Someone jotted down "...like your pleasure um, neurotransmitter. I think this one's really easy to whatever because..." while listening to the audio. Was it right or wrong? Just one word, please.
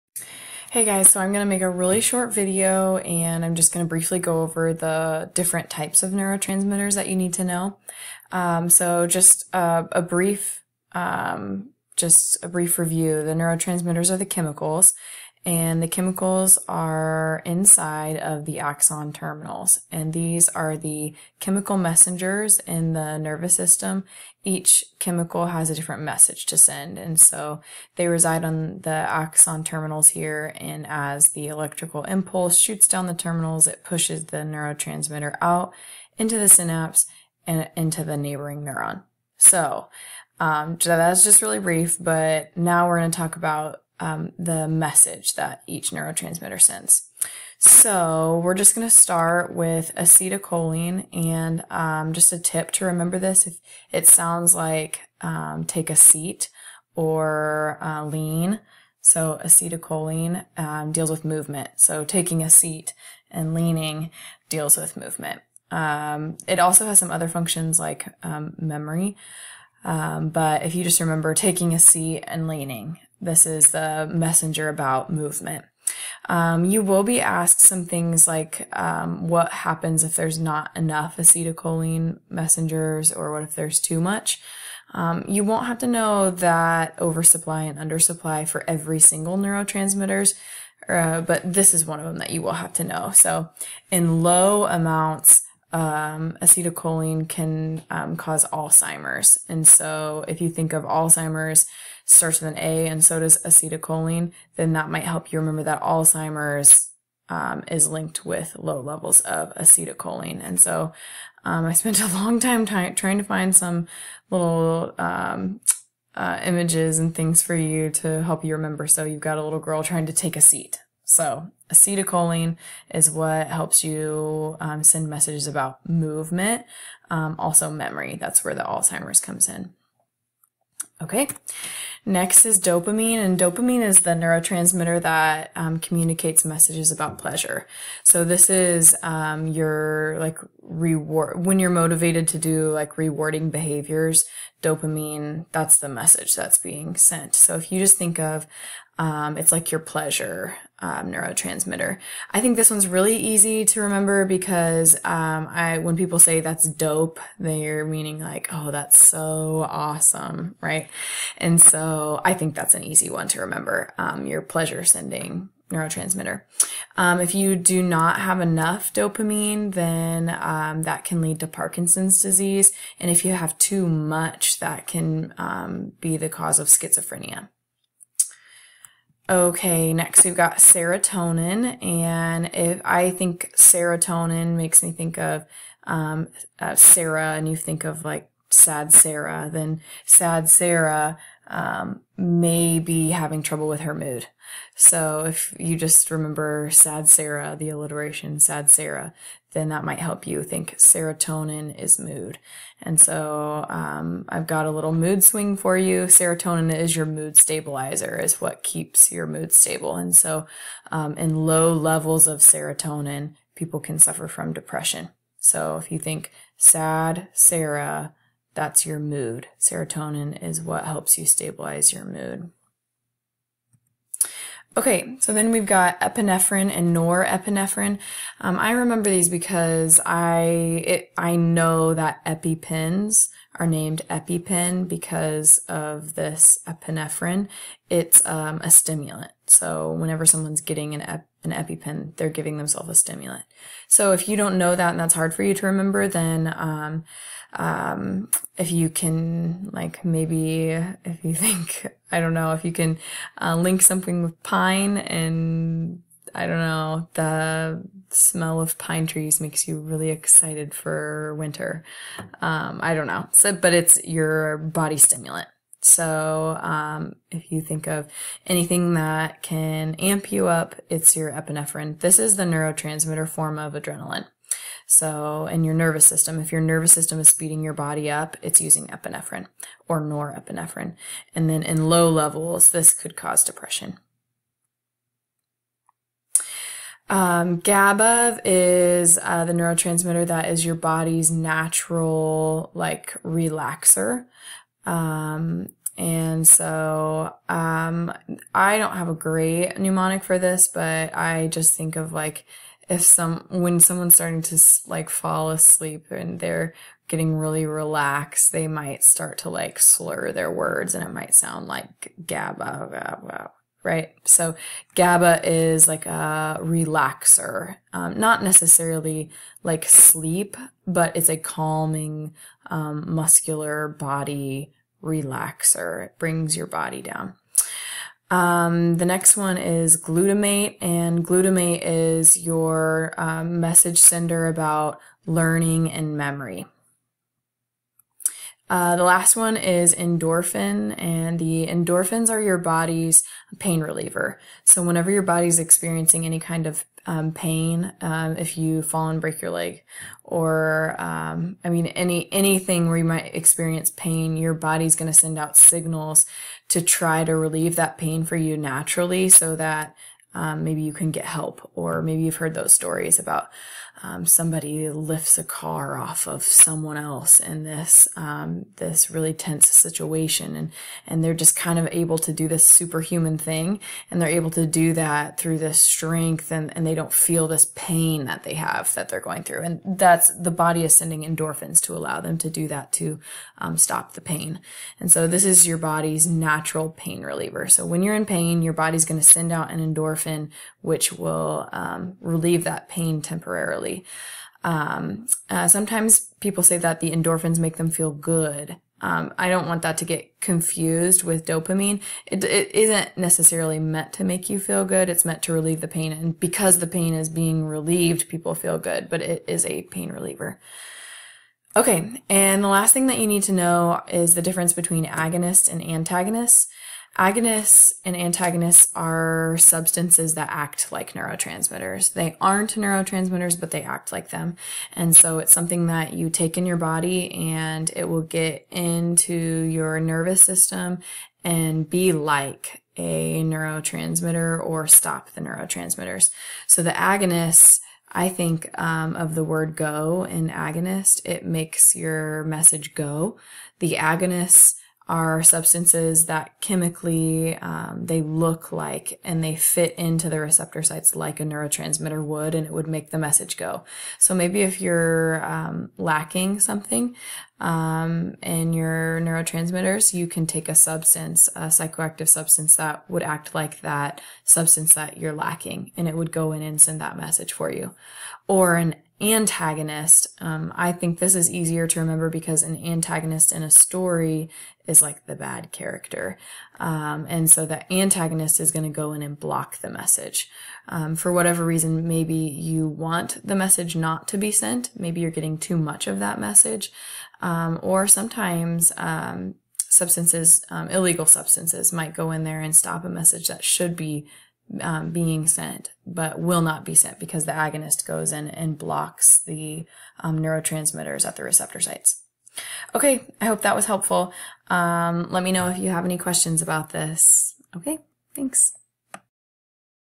wrong.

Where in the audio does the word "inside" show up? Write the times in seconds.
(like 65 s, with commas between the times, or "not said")
17 s.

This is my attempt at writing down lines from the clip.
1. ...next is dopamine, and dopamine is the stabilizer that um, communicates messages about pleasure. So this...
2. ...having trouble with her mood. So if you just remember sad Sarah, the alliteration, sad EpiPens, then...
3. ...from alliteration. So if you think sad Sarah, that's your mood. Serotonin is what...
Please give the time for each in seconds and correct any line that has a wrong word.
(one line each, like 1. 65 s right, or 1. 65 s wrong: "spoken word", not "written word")
1. 132 s wrong: "neurotransmitter", not "stabilizer"
2. 193 s wrong: "Sarah", not "EpiPens"
3. 214 s wrong: "depression", not "alliteration".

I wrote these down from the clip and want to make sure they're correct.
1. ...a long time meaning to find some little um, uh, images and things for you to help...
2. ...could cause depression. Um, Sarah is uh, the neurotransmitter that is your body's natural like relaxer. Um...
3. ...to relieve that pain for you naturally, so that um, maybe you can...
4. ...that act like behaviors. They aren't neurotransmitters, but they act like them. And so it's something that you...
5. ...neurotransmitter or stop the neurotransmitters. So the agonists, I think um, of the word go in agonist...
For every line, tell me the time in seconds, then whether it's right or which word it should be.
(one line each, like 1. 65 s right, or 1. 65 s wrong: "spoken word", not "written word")
1. 112 s wrong: "trying", not "meaning"
2. 282 s wrong: "GABA", not "Sarah"
3. 357 s right
4. 420 s wrong: "neurotransmitters", not "behaviors"
5. 433 s right.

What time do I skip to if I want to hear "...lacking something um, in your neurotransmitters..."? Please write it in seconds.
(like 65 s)
455 s.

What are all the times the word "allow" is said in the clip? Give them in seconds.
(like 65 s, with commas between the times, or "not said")
381 s.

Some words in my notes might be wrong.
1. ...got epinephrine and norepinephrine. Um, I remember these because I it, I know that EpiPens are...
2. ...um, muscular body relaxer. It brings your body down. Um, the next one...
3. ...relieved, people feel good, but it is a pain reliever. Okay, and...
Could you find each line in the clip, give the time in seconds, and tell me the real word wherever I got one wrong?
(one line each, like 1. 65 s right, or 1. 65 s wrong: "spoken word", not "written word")
1. 225 s right
2. 322 s right
3. 407 s right.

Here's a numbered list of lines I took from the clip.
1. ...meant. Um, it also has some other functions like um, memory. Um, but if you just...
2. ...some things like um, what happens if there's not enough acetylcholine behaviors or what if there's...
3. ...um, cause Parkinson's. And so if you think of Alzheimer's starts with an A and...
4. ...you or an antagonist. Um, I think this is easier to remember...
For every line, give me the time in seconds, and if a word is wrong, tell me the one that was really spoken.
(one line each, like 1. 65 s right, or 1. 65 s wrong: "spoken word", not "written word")
1. 64 s wrong: "movement", not "meant"
2. 77 s wrong: "messengers", not "behaviors"
3. 97 s wrong: "Alzheimer", not "Parkinson"
4. 467 s right.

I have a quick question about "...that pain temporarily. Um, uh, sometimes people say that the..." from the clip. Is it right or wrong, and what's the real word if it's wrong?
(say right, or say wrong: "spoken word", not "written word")
right.